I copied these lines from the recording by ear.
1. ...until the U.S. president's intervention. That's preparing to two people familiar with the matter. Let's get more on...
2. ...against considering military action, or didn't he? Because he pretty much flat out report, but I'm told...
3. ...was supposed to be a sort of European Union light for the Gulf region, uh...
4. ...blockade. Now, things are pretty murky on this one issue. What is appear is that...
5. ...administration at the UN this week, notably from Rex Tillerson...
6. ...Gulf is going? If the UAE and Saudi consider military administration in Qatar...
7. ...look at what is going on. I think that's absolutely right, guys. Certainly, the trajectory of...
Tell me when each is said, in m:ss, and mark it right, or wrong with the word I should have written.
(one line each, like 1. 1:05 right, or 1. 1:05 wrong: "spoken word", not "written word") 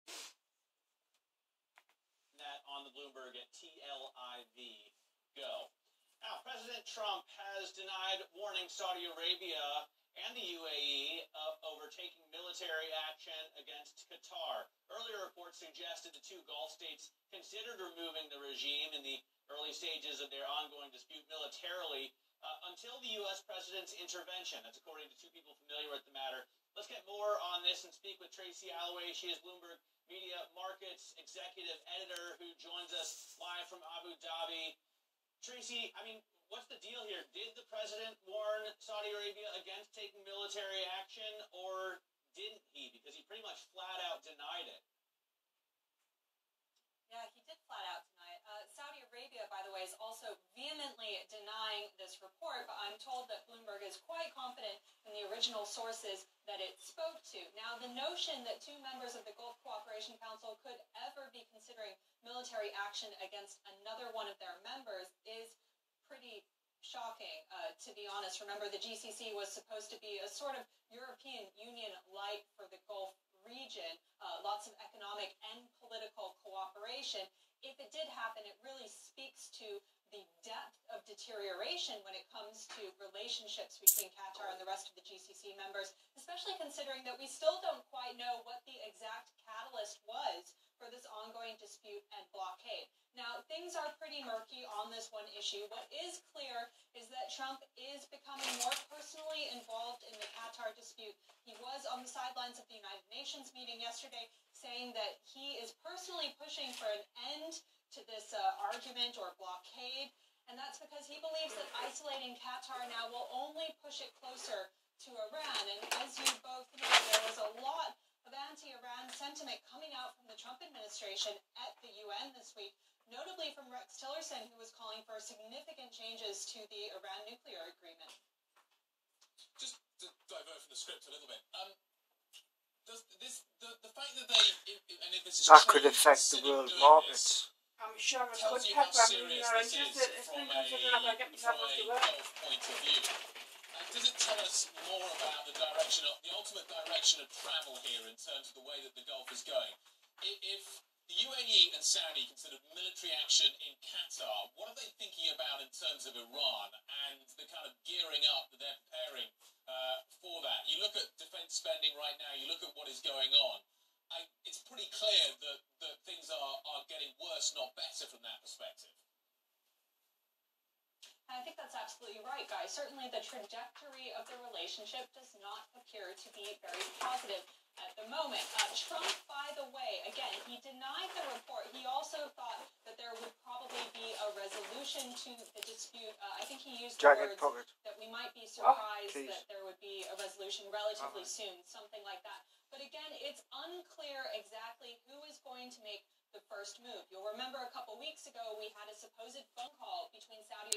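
1. 0:22 wrong: "according", not "preparing"
2. 0:39 wrong: "taking", not "considering"
3. 1:09 right
4. 1:32 wrong: "clear", not "appear"
5. 2:00 right
6. 2:29 wrong: "action", not "administration"
7. 2:42 right.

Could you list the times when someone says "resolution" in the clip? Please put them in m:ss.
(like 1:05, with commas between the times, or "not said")
3:04, 3:10.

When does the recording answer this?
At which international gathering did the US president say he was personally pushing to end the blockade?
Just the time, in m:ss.
1:42.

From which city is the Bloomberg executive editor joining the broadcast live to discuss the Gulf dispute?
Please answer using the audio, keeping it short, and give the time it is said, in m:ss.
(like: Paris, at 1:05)
Abu Dhabi, at 0:33.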